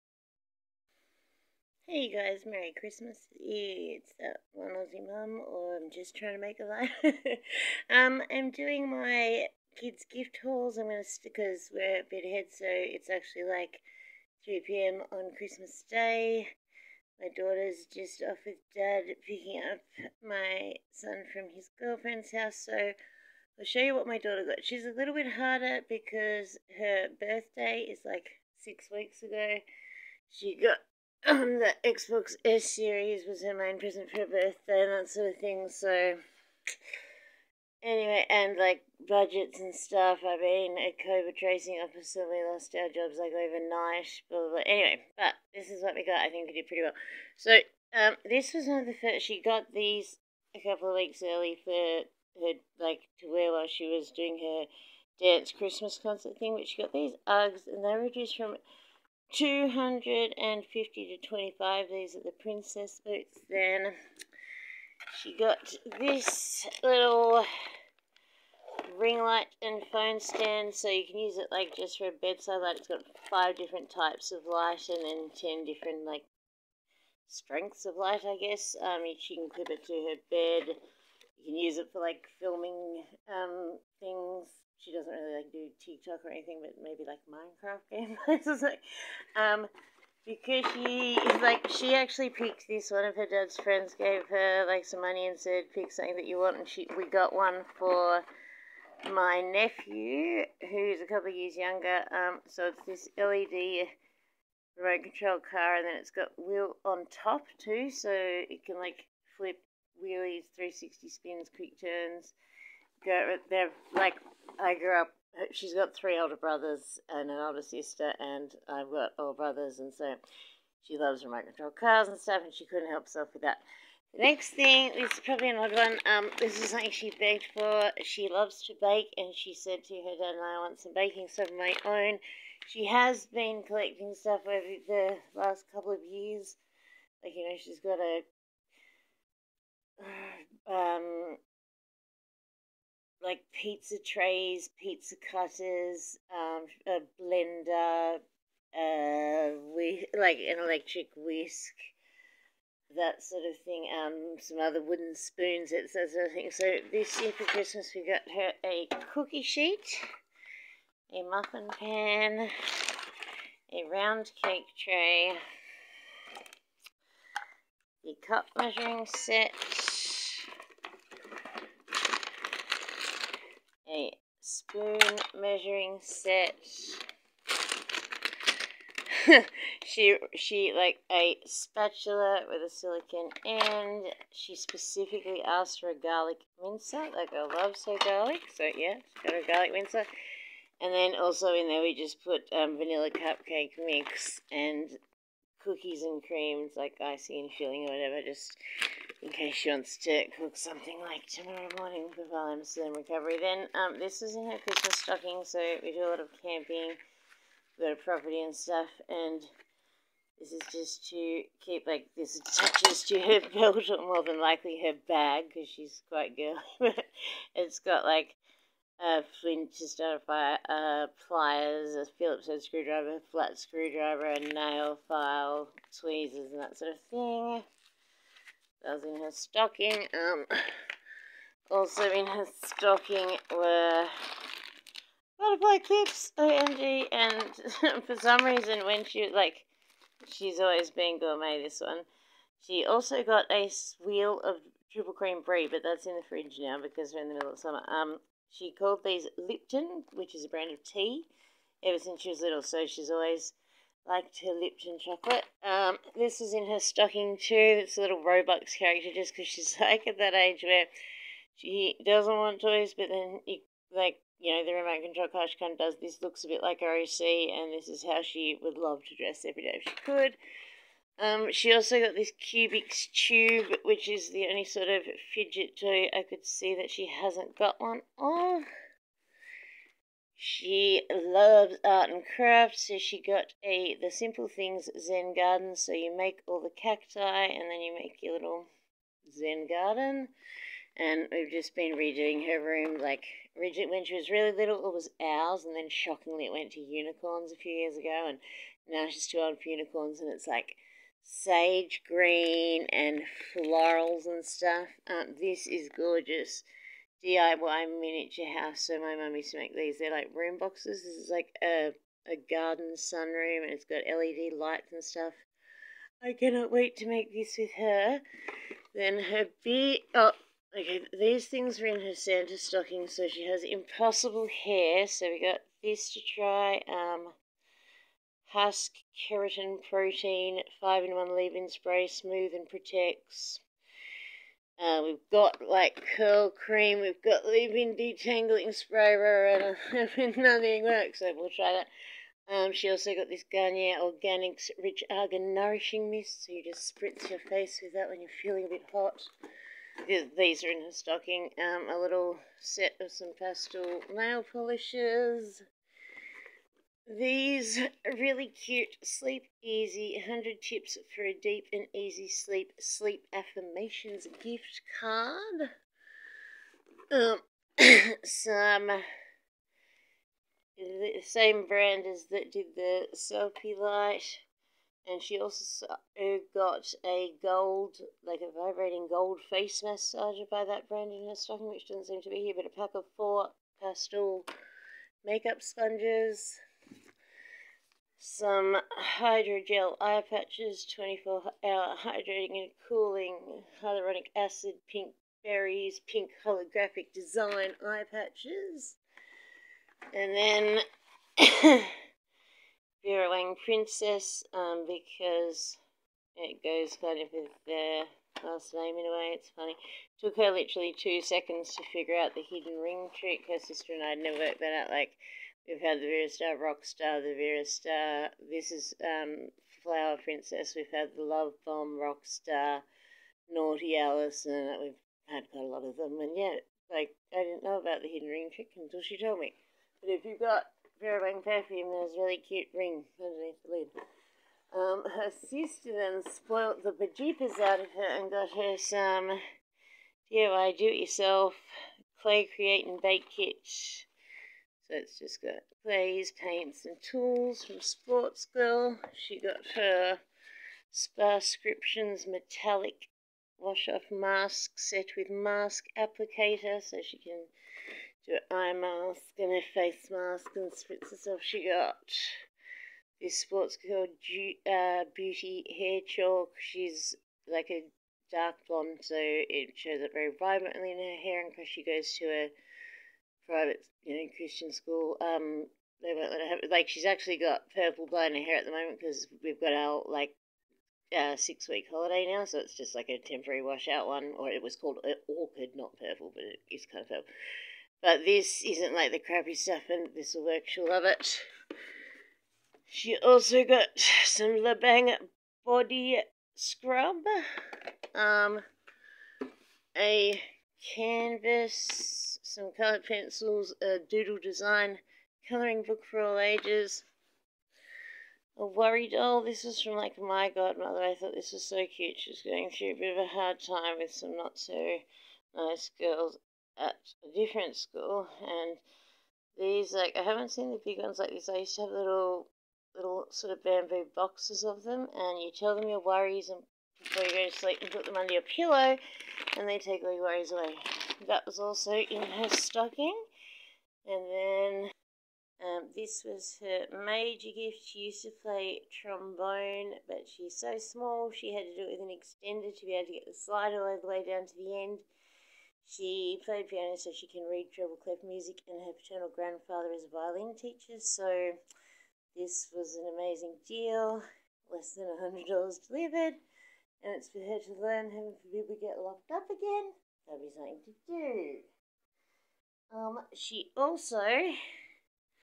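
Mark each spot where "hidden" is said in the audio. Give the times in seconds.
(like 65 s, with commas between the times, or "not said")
412 s, 428 s.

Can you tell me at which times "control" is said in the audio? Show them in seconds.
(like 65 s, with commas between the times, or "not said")
105 s, 121 s, 265 s.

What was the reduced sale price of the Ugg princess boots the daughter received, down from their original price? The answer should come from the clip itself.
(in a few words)
$25.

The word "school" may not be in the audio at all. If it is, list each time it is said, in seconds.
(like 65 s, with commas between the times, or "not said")
474 s, 517 s.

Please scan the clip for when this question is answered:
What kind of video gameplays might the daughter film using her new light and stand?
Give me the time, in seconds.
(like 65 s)
87 s.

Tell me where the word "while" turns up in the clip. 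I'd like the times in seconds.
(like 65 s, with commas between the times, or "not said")
53 s, 202 s.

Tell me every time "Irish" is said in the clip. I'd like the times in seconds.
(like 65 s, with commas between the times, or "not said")
not said.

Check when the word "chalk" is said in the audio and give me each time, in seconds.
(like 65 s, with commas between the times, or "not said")
466 s.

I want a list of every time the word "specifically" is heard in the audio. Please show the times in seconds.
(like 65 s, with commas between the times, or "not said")
184 s.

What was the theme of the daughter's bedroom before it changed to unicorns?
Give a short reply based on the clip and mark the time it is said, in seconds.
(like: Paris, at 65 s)
Owls, at 295 s.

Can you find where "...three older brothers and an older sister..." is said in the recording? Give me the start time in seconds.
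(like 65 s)
115 s.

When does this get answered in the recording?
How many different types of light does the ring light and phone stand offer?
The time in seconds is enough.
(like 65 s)
73 s.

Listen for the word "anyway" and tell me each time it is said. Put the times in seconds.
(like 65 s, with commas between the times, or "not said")
37 s, 44 s.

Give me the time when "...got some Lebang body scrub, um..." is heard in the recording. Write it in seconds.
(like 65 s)
493 s.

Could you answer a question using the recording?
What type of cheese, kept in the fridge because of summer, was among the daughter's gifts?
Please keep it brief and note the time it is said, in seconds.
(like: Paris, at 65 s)
Triple cream brie, at 244 s.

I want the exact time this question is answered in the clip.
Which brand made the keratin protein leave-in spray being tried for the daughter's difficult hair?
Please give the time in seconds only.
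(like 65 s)
328 s.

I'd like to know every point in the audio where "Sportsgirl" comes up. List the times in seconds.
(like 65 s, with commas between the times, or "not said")
447 s, 463 s.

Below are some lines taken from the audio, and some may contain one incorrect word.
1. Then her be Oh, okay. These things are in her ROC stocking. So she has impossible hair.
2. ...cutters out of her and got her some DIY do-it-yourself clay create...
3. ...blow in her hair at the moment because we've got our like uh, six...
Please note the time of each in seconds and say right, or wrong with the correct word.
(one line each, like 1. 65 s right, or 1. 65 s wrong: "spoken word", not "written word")
1. 318 s wrong: "Santa", not "ROC"
2. 436 s wrong: "bejeepers", not "cutters"
3. 478 s right.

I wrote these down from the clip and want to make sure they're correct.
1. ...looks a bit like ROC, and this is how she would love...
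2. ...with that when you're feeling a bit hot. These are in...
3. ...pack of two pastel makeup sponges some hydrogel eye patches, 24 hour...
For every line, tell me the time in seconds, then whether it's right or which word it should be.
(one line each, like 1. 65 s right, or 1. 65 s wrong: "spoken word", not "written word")
1. 266 s right
2. 347 s right
3. 382 s wrong: "four", not "two".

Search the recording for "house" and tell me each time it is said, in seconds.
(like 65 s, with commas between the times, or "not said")
22 s, 308 s.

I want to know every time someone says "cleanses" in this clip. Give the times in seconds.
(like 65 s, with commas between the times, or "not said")
not said.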